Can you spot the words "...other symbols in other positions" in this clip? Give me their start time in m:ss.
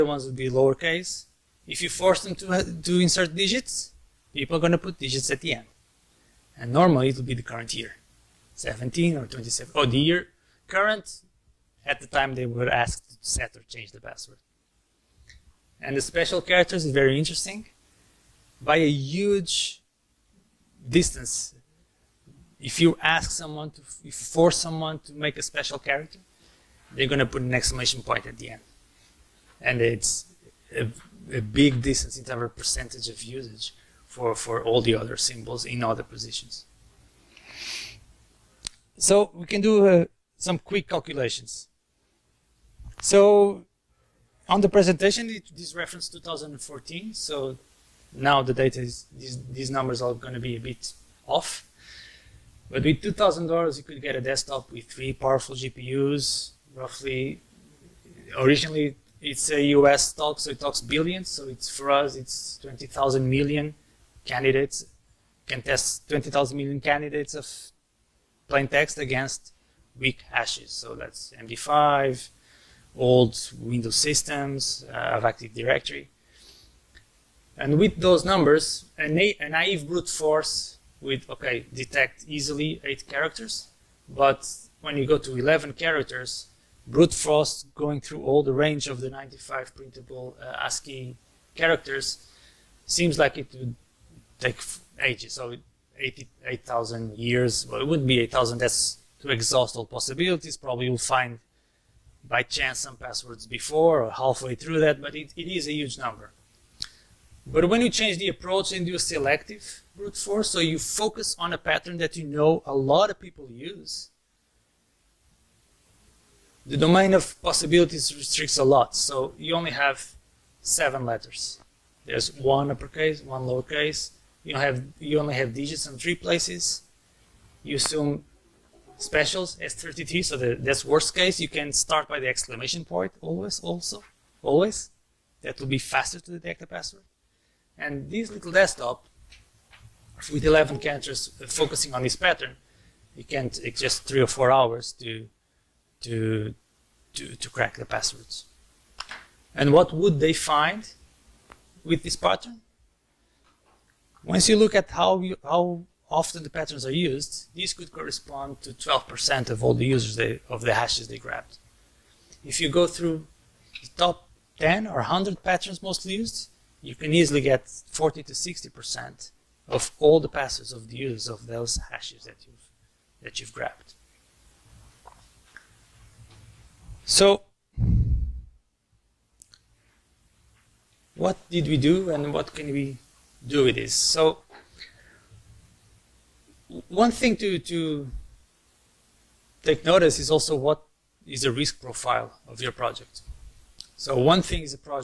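0:34.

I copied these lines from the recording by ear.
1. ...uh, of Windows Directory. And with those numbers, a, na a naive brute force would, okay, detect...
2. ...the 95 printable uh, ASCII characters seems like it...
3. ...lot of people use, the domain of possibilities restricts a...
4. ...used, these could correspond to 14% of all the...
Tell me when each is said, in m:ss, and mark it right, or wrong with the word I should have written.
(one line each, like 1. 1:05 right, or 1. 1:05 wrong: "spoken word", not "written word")
1. 1:14 wrong: "Active", not "Windows"
2. 1:28 right
3. 1:52 right
4. 2:36 wrong: "12", not "14".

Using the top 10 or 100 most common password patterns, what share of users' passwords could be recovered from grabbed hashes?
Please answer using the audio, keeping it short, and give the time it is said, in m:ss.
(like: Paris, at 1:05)
40 to 60%, at 2:47.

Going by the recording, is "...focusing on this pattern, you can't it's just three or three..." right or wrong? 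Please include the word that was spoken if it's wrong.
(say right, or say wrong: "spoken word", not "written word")
wrong: "four", not "three".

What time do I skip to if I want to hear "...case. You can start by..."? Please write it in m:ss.
2:11.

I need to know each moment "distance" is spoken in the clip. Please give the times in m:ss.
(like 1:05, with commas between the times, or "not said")
0:20, 0:31.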